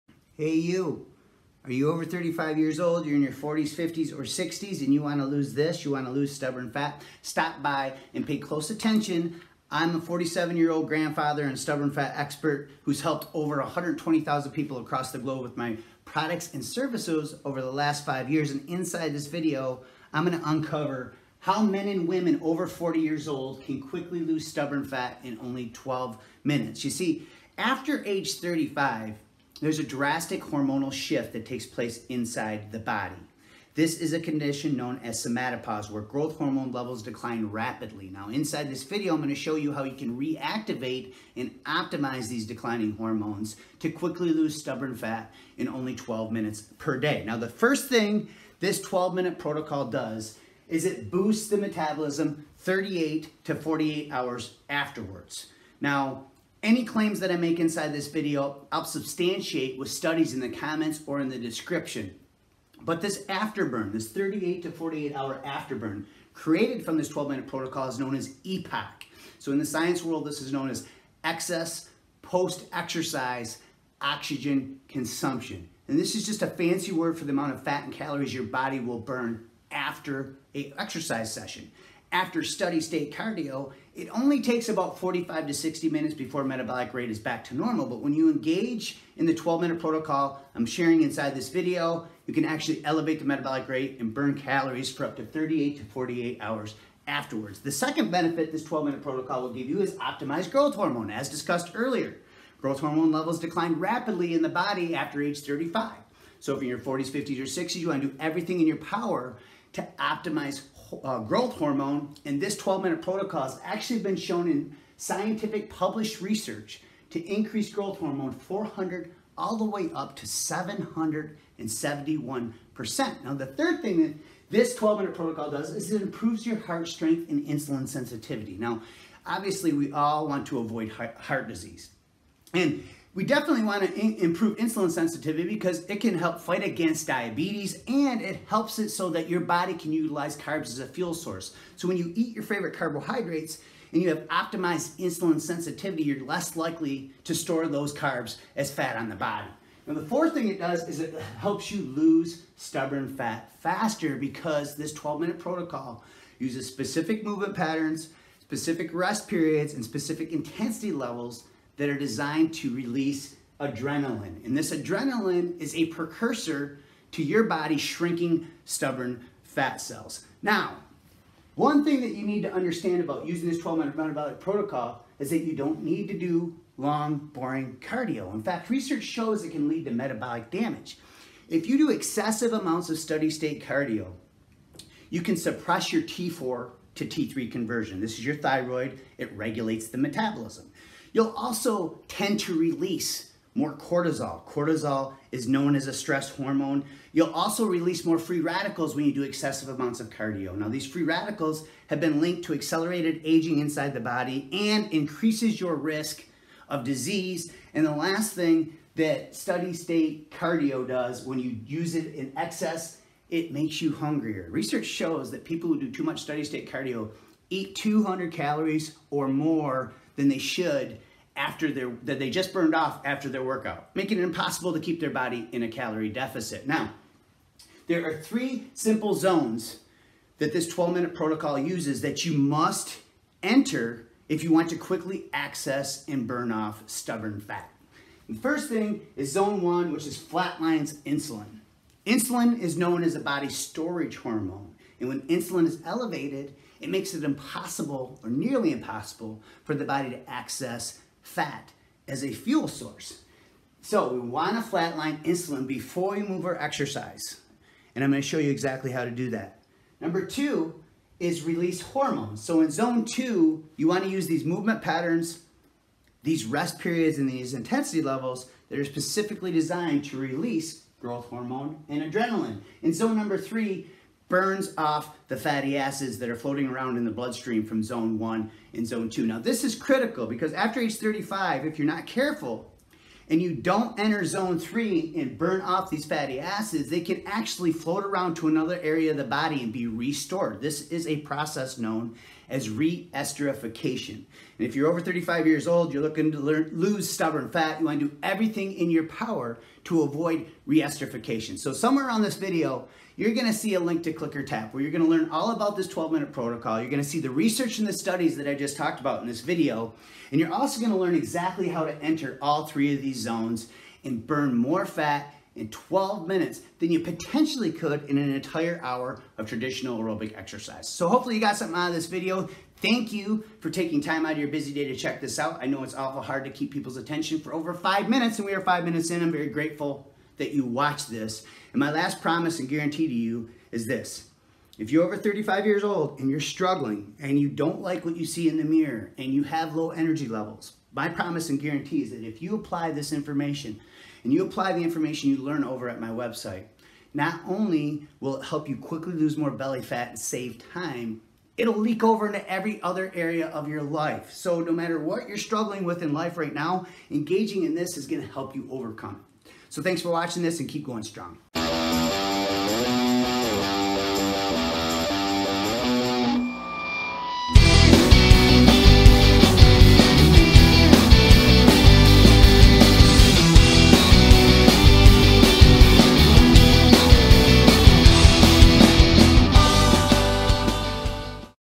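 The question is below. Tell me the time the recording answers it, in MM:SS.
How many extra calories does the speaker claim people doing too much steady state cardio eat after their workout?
03:37.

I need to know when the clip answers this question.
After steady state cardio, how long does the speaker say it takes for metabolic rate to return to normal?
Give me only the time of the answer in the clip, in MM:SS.
01:24.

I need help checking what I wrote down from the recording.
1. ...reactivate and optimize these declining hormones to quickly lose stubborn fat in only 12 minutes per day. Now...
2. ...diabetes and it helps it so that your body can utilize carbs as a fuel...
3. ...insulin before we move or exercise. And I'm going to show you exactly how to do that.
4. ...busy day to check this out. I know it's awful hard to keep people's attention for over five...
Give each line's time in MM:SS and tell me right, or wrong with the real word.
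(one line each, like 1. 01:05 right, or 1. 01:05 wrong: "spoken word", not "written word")
1. 00:40 right
2. 02:17 right
3. 04:15 right
4. 05:24 right.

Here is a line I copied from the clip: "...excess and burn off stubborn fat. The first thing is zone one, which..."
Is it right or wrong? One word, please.
wrong.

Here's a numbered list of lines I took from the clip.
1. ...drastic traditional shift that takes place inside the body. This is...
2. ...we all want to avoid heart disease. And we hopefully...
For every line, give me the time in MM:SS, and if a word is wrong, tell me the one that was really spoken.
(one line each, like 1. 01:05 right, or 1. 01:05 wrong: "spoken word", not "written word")
1. 00:29 wrong: "hormonal", not "traditional"
2. 02:09 wrong: "definitely", not "hopefully".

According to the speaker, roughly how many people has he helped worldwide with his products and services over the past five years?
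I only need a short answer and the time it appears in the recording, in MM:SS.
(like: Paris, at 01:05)
120,000, at 00:13.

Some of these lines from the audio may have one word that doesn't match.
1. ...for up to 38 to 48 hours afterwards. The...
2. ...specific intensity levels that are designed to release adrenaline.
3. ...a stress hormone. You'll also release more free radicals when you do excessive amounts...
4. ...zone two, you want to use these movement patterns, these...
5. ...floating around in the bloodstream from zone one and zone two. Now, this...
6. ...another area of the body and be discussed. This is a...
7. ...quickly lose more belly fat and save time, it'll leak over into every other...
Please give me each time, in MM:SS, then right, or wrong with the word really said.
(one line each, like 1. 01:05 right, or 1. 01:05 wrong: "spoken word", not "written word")
1. 01:34 right
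2. 02:39 right
3. 03:15 right
4. 04:22 right
5. 04:36 right
6. 04:48 wrong: "restored", not "discussed"
7. 05:48 right.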